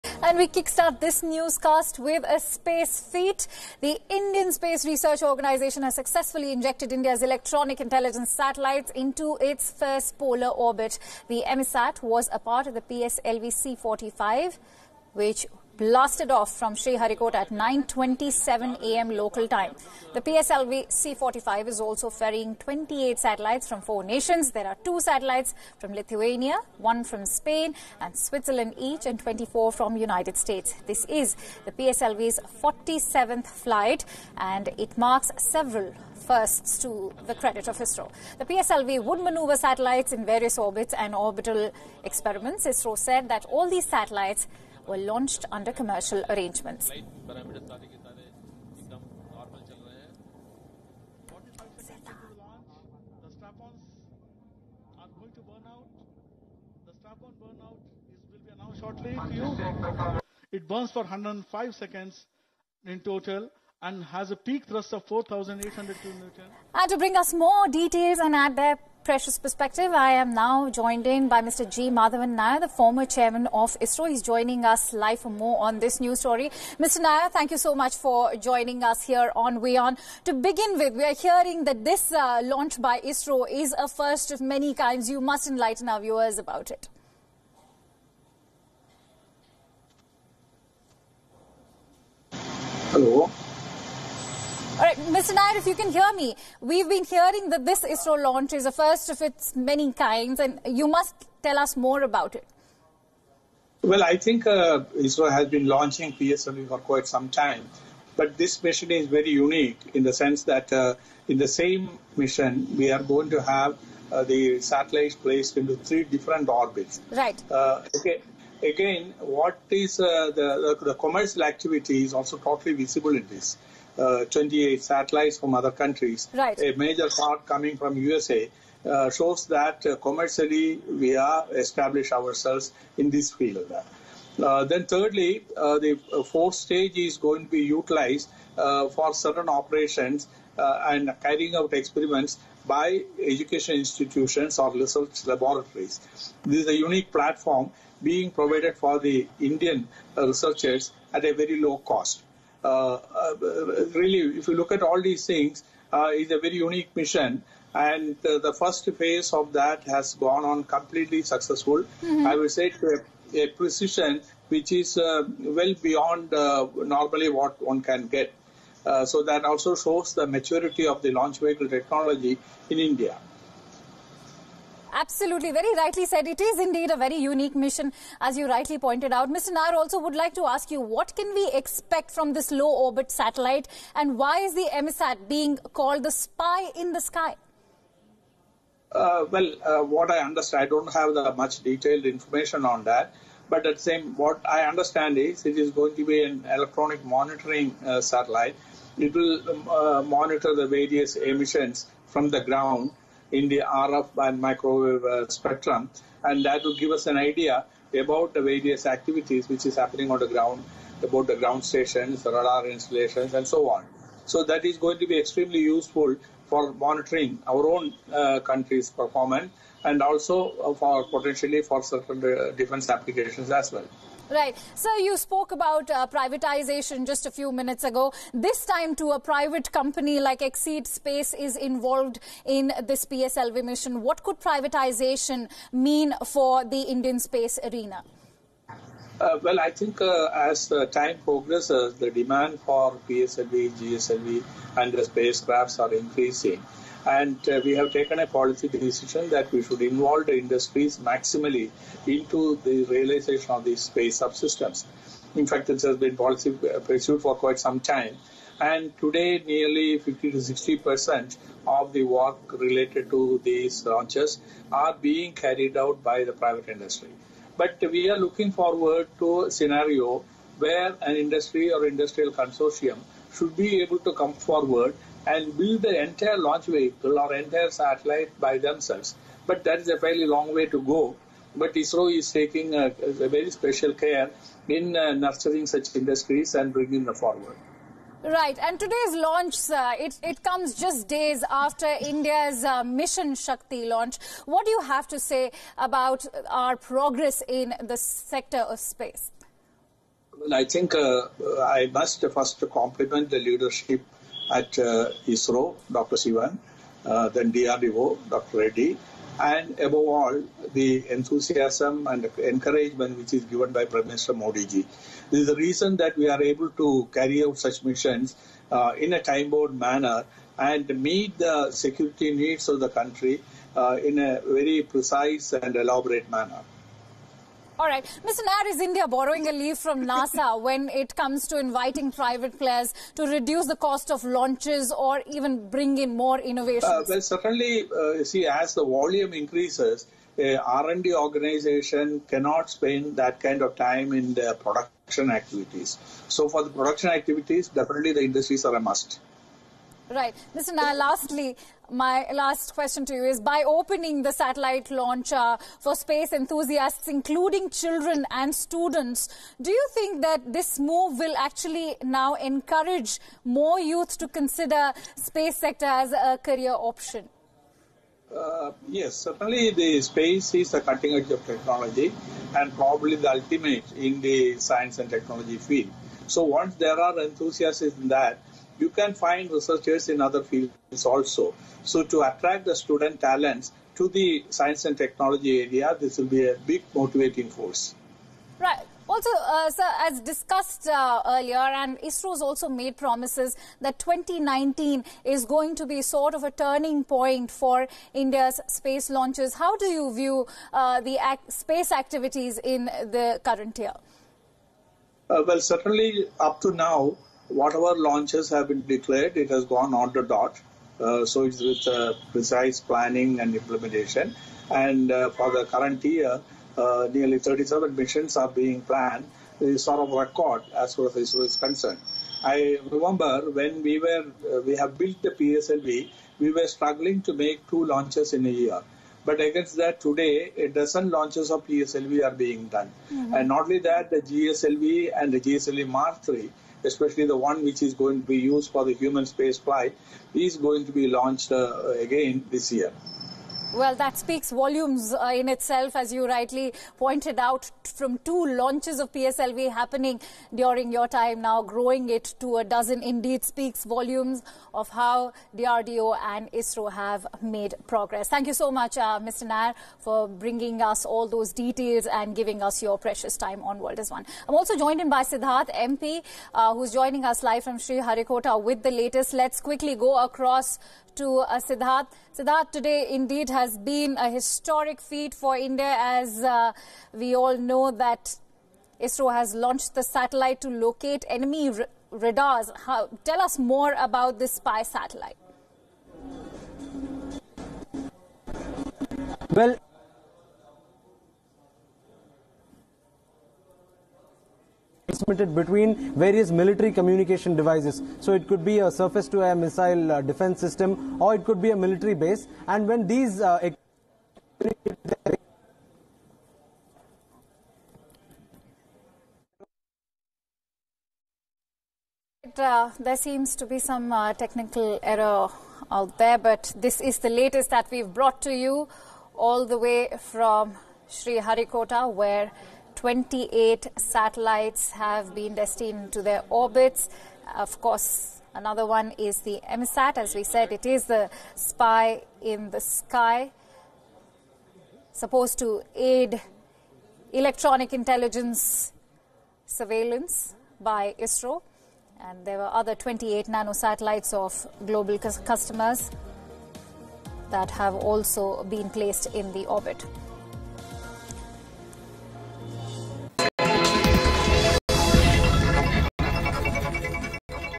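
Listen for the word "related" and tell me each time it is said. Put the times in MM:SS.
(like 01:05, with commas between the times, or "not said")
04:22.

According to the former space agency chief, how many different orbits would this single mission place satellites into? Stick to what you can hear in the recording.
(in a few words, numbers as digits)
3.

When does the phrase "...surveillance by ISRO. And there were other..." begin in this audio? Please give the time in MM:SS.
08:59.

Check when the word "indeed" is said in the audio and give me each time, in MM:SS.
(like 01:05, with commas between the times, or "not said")
02:56, 07:33, 07:53.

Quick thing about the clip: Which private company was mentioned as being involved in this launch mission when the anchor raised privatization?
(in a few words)
Exseed Space.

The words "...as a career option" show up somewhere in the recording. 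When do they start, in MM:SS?
06:05.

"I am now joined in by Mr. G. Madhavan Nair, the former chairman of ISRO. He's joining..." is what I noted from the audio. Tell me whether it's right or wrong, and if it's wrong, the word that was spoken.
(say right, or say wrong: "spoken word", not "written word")
right.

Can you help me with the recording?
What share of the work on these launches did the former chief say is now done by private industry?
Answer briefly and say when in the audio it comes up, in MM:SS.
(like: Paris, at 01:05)
50 to 60 percent, at 04:19.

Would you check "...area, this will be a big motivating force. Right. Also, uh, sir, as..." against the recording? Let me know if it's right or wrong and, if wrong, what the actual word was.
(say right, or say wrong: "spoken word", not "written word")
right.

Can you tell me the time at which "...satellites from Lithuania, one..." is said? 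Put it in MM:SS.
00:24.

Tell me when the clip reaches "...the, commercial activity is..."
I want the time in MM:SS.
02:00.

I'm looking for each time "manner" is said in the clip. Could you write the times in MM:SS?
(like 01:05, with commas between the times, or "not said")
05:19, 05:26.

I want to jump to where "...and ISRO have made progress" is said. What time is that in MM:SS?
07:36.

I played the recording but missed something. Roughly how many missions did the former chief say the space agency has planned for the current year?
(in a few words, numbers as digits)
37.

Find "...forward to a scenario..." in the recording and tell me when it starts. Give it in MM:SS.
04:28.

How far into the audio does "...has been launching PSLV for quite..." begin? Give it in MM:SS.
01:45.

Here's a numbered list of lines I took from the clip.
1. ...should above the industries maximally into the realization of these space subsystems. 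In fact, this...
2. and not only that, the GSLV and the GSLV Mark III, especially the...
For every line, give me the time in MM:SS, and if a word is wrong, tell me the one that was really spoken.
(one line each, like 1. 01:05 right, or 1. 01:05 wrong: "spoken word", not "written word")
1. 04:09 wrong: "involve", not "above"
2. 07:13 right.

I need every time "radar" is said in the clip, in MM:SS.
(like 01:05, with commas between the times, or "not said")
03:32, 08:02.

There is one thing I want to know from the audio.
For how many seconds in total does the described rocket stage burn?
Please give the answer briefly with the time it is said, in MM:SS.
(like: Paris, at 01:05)
105 seconds, at 01:01.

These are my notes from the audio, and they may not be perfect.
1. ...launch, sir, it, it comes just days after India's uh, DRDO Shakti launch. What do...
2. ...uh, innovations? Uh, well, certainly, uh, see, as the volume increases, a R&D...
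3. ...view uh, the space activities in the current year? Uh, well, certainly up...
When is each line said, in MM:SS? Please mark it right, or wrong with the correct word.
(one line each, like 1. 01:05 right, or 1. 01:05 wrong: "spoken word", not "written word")
1. 04:49 wrong: "Mission", not "DRDO"
2. 05:36 right
3. 06:40 right.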